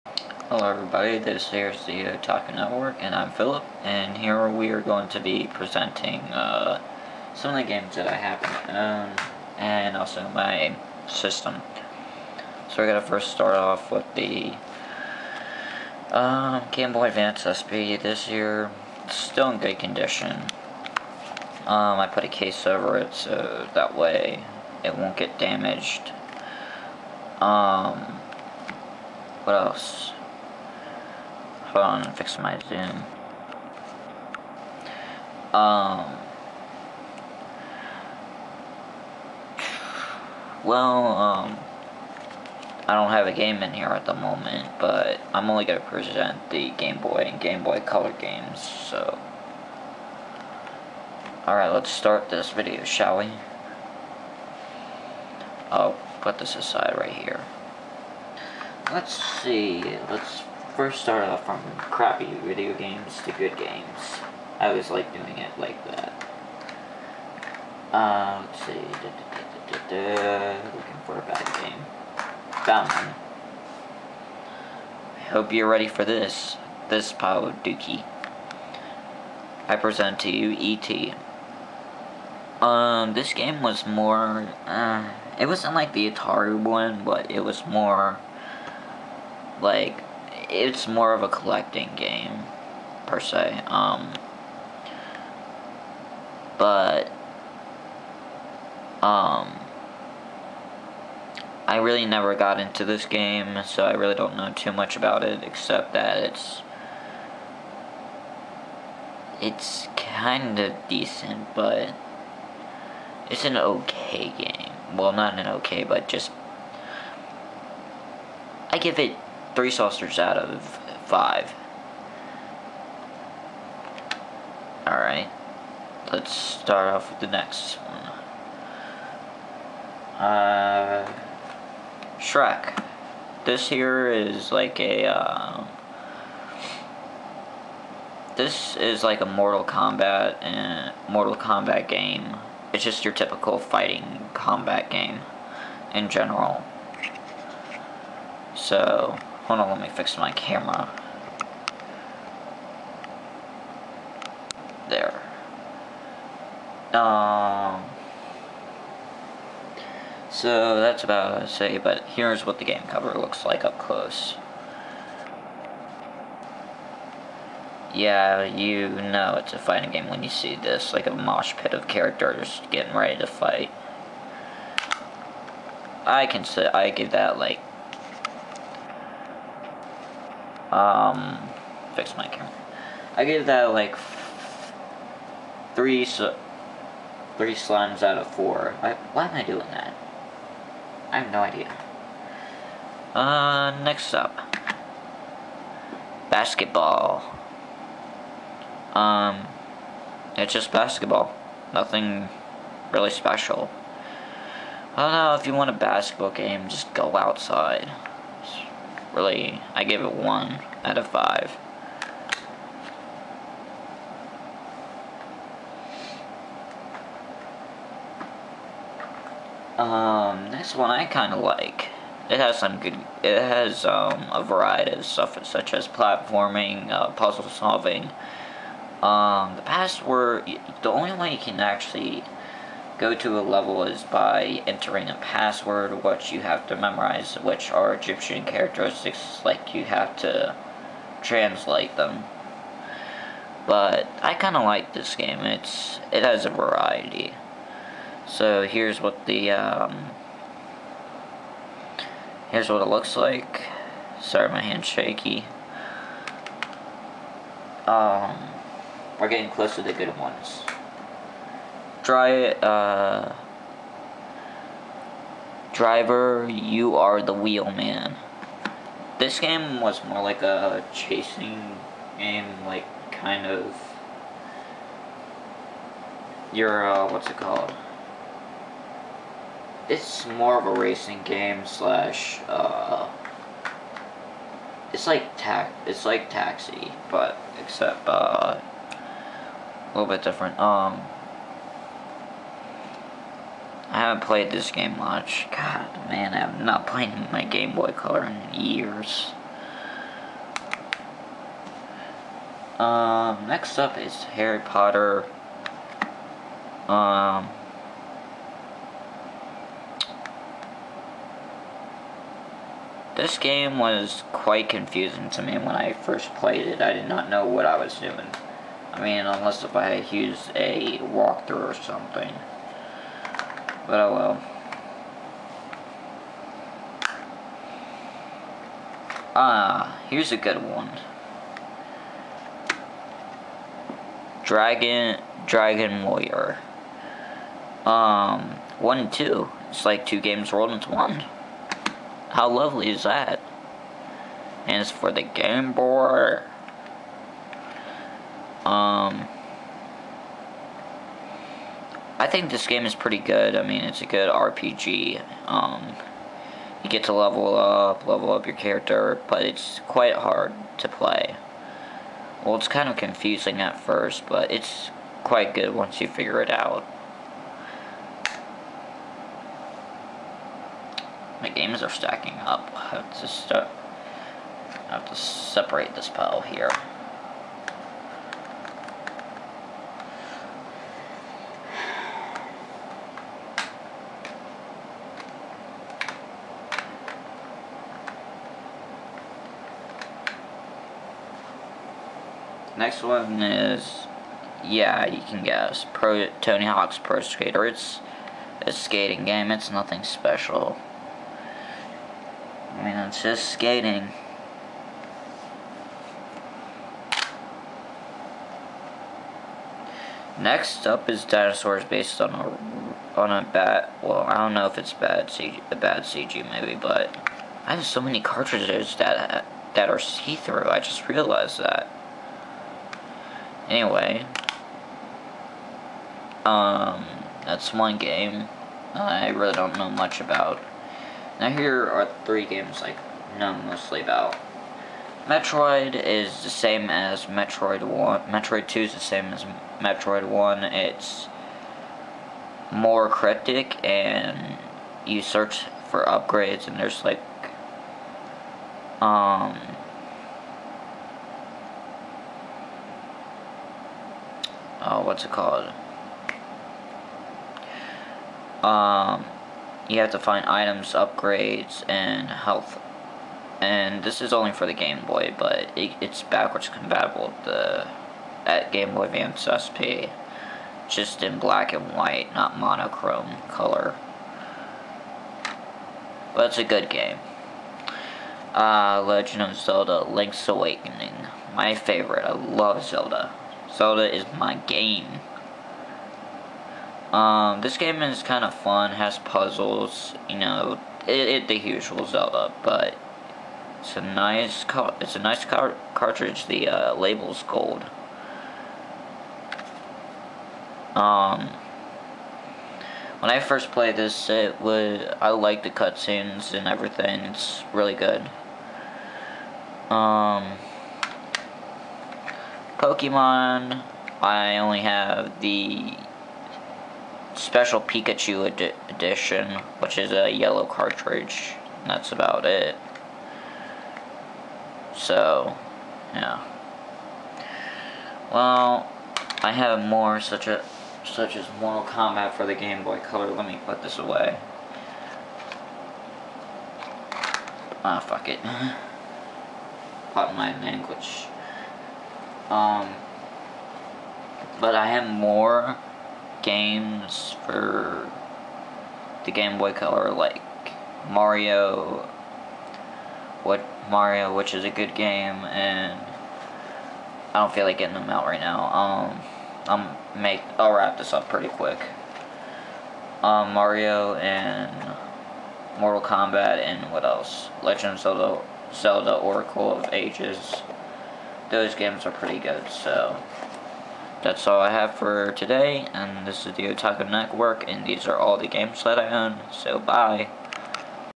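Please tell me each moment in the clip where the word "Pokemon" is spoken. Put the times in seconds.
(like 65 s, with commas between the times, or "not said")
512 s.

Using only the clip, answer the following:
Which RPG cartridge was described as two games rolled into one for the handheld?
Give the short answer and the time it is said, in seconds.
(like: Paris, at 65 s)
Dragon Warrior 1 and 2, at 335 s.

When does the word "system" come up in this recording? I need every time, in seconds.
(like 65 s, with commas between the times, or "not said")
11 s.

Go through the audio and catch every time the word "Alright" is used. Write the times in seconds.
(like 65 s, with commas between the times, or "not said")
51 s, 124 s.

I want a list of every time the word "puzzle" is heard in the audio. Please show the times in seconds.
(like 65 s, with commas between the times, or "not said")
227 s, 489 s.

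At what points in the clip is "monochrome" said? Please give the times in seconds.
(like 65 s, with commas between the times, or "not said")
472 s.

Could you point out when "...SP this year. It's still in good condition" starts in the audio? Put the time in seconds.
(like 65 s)
17 s.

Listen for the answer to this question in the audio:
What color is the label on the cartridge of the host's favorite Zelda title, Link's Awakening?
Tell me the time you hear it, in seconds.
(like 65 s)
497 s.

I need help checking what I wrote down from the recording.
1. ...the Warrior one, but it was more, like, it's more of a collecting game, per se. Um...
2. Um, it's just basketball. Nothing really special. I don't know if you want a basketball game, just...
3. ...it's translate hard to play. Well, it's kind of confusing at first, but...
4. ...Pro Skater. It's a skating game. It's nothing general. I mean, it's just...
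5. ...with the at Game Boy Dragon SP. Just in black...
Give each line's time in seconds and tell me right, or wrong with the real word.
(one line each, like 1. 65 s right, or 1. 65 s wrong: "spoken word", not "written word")
1. 85 s wrong: "Atari", not "Warrior"
2. 198 s right
3. 359 s wrong: "quite", not "translate"
4. 396 s wrong: "special", not "general"
5. 467 s wrong: "Advance", not "Dragon".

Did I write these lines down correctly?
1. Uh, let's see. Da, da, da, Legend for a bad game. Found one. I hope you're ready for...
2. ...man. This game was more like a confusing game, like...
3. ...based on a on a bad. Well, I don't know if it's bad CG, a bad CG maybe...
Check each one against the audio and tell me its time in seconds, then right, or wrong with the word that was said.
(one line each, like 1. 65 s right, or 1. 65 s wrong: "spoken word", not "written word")
1. 67 s wrong: "Looking", not "Legend"
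2. 267 s wrong: "chasing", not "confusing"
3. 411 s right.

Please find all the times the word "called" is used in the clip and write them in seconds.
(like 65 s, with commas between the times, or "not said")
277 s, 455 s.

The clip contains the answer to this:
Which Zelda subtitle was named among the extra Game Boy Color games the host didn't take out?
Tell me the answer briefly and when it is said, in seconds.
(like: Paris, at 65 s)
Oracle of Ages, at 569 s.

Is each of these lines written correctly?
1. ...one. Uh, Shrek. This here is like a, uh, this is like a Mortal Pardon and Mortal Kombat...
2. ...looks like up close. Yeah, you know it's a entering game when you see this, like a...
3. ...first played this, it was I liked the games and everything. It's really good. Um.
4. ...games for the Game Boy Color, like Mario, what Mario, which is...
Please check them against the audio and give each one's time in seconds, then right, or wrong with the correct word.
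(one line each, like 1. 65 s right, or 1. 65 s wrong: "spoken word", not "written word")
1. 127 s wrong: "Kombat", not "Pardon"
2. 163 s wrong: "fighting", not "entering"
3. 503 s wrong: "cutscenes", not "games"
4. 546 s right.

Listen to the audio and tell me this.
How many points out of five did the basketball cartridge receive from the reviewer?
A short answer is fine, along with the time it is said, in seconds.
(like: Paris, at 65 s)
1, at 210 s.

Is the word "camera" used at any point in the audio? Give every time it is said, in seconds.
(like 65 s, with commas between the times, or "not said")
150 s, 182 s.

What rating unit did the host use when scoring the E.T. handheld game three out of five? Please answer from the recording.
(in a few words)
Saucers.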